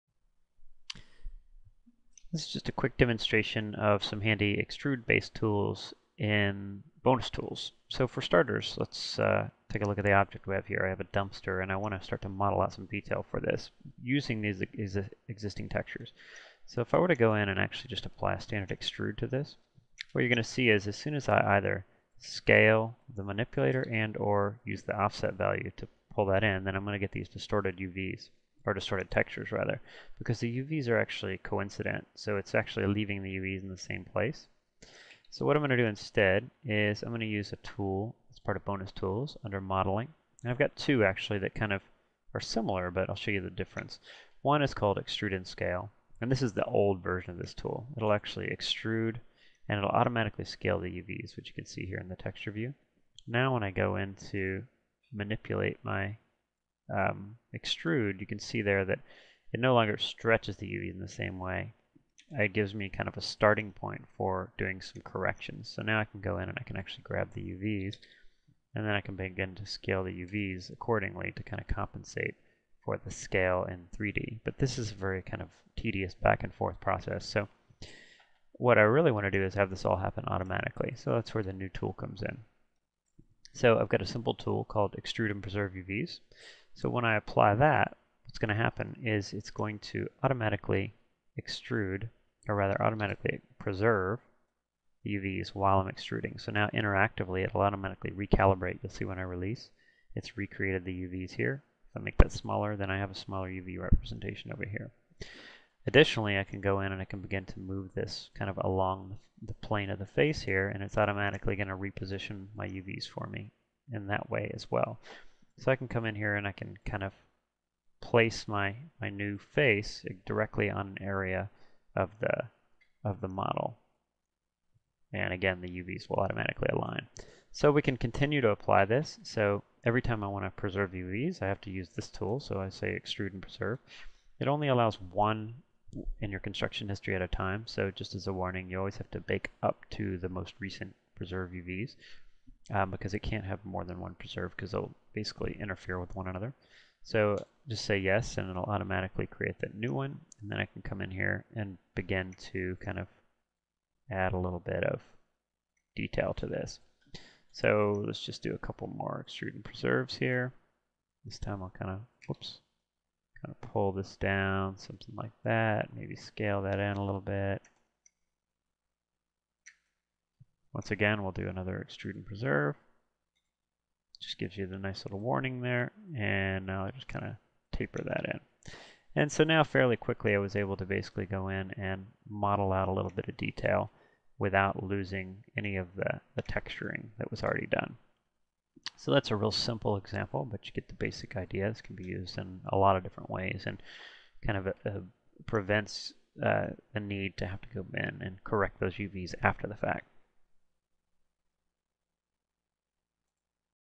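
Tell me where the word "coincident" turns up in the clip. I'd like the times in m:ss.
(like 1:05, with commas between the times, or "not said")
0:31.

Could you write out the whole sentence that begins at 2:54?
Just gives you the nice little warning there, and now I just kind of taper that in.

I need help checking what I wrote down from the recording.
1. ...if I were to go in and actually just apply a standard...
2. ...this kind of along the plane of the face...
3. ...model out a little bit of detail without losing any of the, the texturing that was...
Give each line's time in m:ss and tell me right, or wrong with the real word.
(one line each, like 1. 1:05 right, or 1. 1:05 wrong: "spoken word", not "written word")
1. 0:16 right
2. 1:47 right
3. 3:02 right.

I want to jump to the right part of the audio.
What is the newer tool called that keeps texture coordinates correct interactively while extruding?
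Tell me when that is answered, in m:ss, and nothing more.
1:24.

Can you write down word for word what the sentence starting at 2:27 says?
So just say yes, and it'll automatically create that new one.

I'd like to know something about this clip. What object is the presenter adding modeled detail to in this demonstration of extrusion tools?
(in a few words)
A dumpster.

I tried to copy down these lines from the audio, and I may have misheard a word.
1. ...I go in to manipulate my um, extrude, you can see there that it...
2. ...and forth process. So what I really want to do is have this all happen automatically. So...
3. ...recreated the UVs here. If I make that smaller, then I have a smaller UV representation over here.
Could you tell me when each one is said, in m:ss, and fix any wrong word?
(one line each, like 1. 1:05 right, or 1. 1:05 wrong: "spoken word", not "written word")
1. 0:53 right
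2. 1:16 right
3. 1:40 right.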